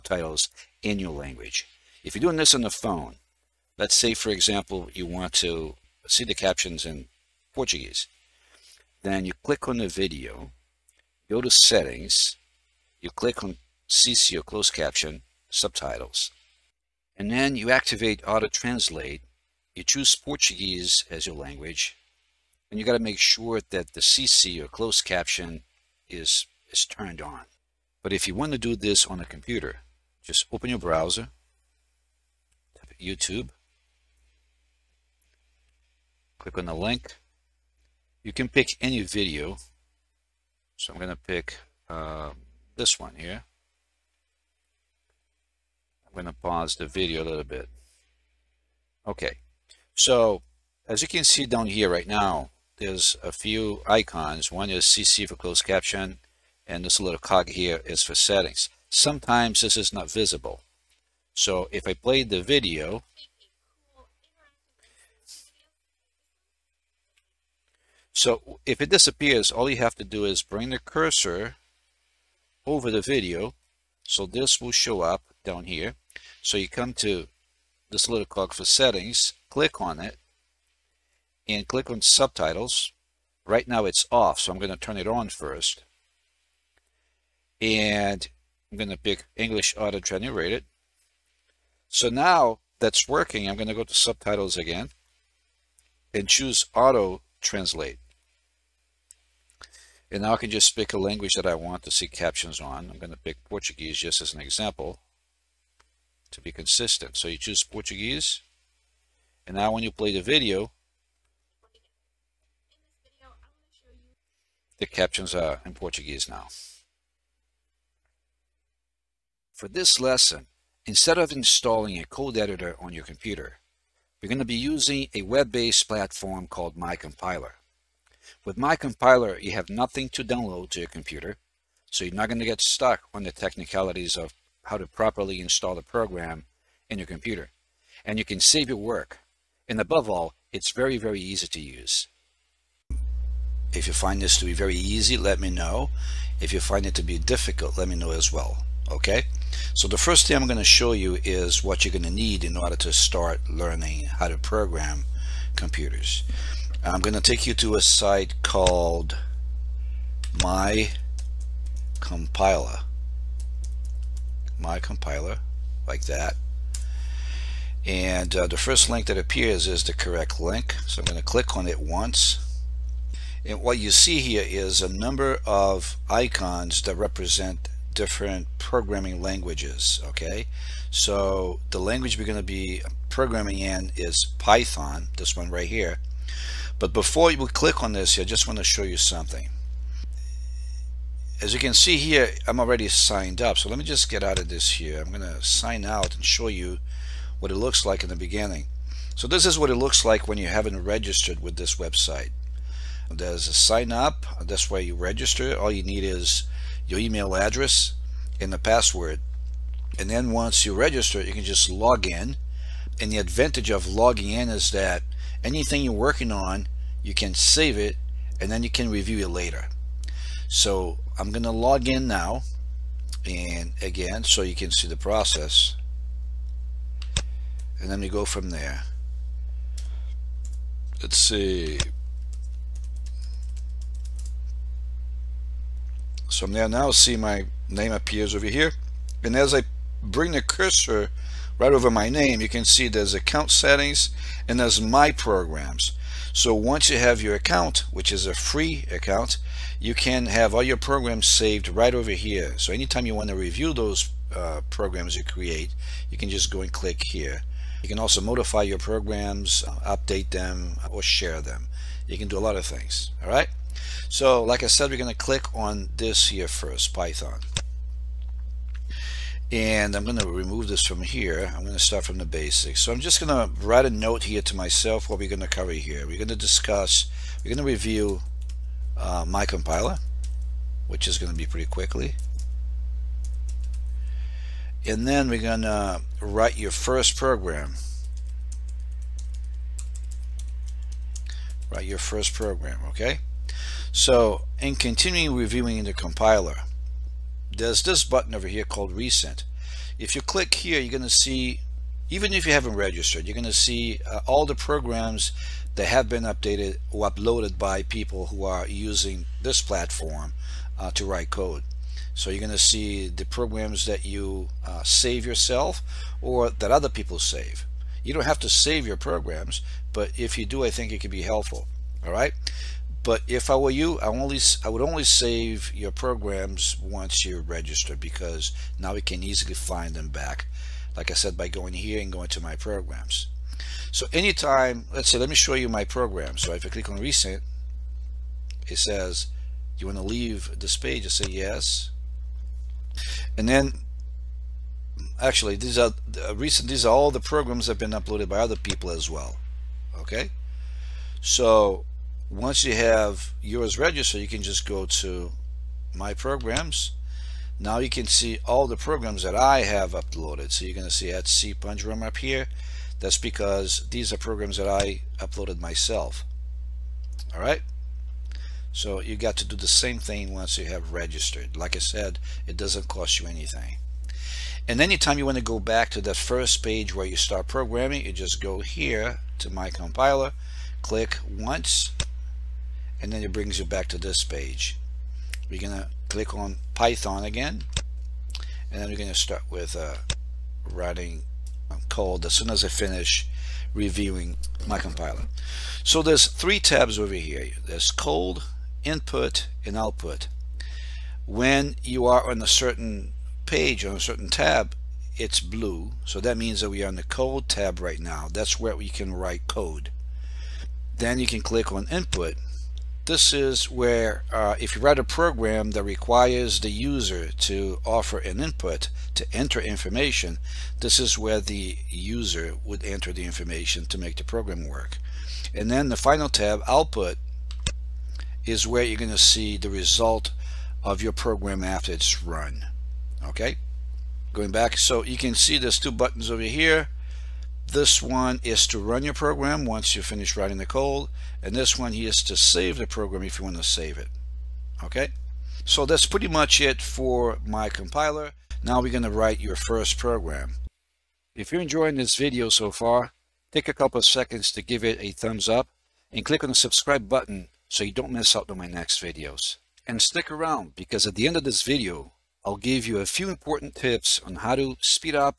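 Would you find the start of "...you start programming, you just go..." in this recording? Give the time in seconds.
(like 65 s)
377 s.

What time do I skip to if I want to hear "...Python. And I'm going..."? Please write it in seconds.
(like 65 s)
266 s.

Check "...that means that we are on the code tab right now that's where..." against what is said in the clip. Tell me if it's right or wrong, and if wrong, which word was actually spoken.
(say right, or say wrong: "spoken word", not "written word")
right.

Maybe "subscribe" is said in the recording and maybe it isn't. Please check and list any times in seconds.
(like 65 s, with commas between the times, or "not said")
456 s.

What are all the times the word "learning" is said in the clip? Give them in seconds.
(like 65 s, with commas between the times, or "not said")
153 s.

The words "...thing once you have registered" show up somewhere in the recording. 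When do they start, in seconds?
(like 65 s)
369 s.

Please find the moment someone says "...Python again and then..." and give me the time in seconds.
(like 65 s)
386 s.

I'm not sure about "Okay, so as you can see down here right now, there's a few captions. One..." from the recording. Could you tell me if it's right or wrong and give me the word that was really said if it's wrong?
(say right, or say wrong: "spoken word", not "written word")
wrong: "icons", not "captions".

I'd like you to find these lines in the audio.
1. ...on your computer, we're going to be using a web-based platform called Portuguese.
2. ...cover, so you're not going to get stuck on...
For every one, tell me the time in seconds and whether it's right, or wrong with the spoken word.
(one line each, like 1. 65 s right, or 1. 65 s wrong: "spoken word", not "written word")
1. 122 s wrong: "MyCompiler", not "Portuguese"
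2. 130 s wrong: "computer", not "cover".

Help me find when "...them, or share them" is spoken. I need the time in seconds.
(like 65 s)
260 s.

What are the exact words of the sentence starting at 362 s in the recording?
That's because these are programs that I uploaded myself.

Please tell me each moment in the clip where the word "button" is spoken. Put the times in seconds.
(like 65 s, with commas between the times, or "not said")
298 s, 435 s, 457 s.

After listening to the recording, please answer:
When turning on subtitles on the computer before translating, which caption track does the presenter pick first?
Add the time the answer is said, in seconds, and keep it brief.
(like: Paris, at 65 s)
English auto generated, at 89 s.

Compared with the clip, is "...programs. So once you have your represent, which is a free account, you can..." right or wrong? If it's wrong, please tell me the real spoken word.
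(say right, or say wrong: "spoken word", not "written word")
wrong: "account", not "represent".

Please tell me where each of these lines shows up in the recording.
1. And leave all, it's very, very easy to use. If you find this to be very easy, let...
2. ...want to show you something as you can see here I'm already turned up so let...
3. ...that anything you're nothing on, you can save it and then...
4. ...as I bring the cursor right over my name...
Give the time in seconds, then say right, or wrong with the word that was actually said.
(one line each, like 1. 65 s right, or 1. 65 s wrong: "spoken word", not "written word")
1. 139 s wrong: "above", not "leave"
2. 188 s wrong: "signed", not "turned"
3. 214 s wrong: "working", not "nothing"
4. 239 s right.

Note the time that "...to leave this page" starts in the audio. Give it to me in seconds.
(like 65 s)
339 s.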